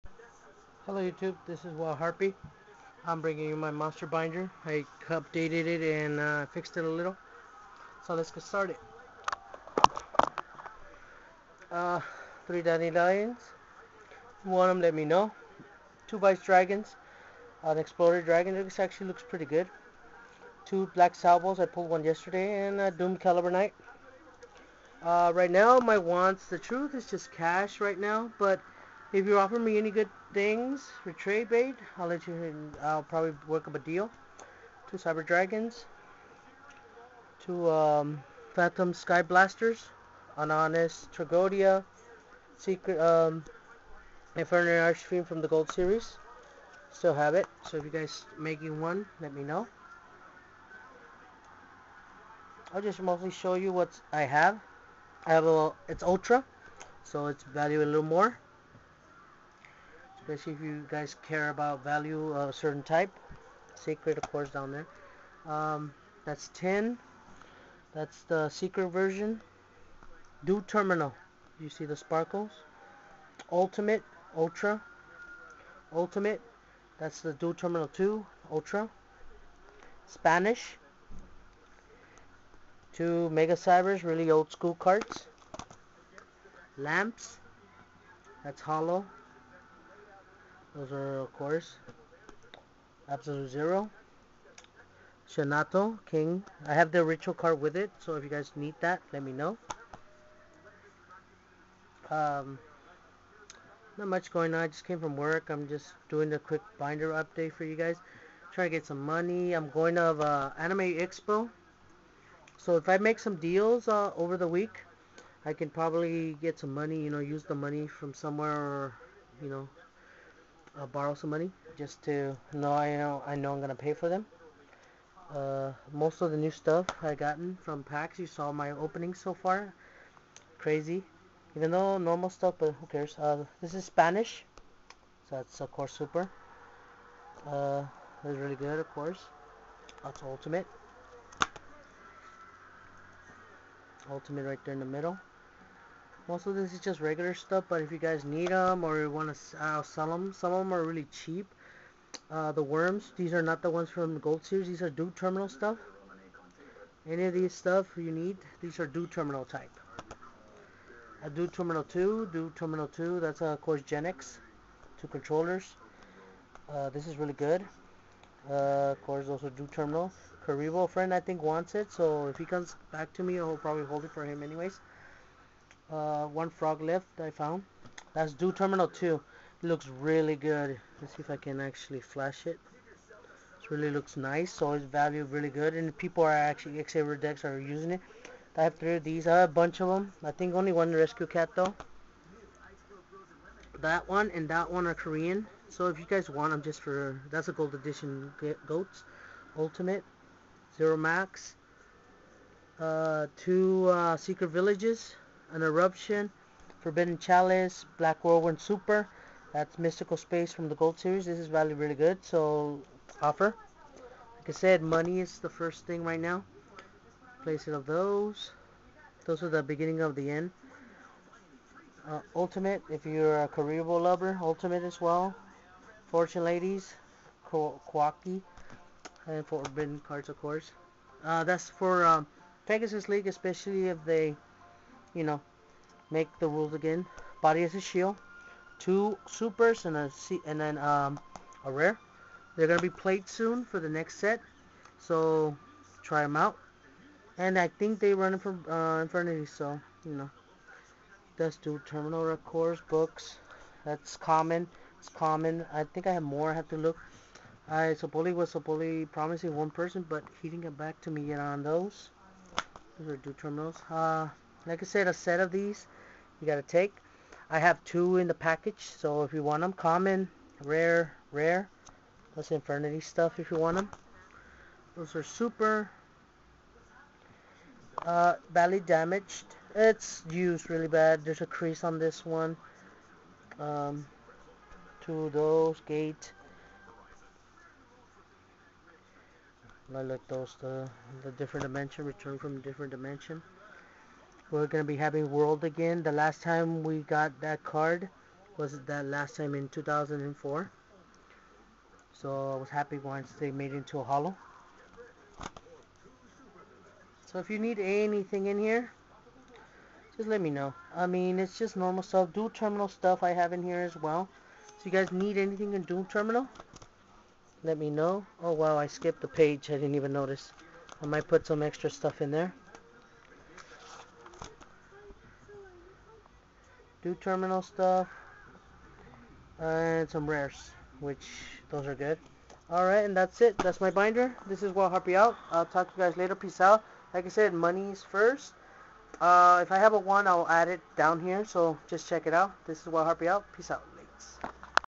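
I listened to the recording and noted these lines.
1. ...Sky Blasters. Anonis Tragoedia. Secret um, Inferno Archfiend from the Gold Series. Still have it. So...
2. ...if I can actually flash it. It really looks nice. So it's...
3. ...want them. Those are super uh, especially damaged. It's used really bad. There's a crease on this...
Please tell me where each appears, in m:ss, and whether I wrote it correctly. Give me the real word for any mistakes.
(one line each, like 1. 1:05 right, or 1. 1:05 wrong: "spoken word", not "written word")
1. 0:38 right
2. 3:01 right
3. 4:33 wrong: "badly", not "especially".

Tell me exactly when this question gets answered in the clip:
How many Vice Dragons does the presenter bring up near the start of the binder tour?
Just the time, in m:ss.
0:16.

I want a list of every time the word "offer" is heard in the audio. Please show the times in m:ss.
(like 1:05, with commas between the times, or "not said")
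0:29, 3:33.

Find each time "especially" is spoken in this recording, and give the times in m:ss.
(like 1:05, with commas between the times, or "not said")
1:00, 3:53.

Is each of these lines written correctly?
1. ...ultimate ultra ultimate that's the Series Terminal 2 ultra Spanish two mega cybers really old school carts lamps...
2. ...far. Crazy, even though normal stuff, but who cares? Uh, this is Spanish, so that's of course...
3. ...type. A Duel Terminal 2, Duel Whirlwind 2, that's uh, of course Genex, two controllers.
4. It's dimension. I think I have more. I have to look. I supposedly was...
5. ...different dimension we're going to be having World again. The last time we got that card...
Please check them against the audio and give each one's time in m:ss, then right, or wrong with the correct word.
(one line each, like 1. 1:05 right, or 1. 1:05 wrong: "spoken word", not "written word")
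1. 1:13 wrong: "Duel", not "Series"
2. 2:09 right
3. 2:39 wrong: "Terminal", not "Whirlwind"
4. 4:14 wrong: "common", not "dimension"
5. 4:52 right.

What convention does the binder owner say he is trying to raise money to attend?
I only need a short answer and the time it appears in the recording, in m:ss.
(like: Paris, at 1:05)
Anime Expo, at 1:50.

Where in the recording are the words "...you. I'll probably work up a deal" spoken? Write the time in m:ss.
0:32.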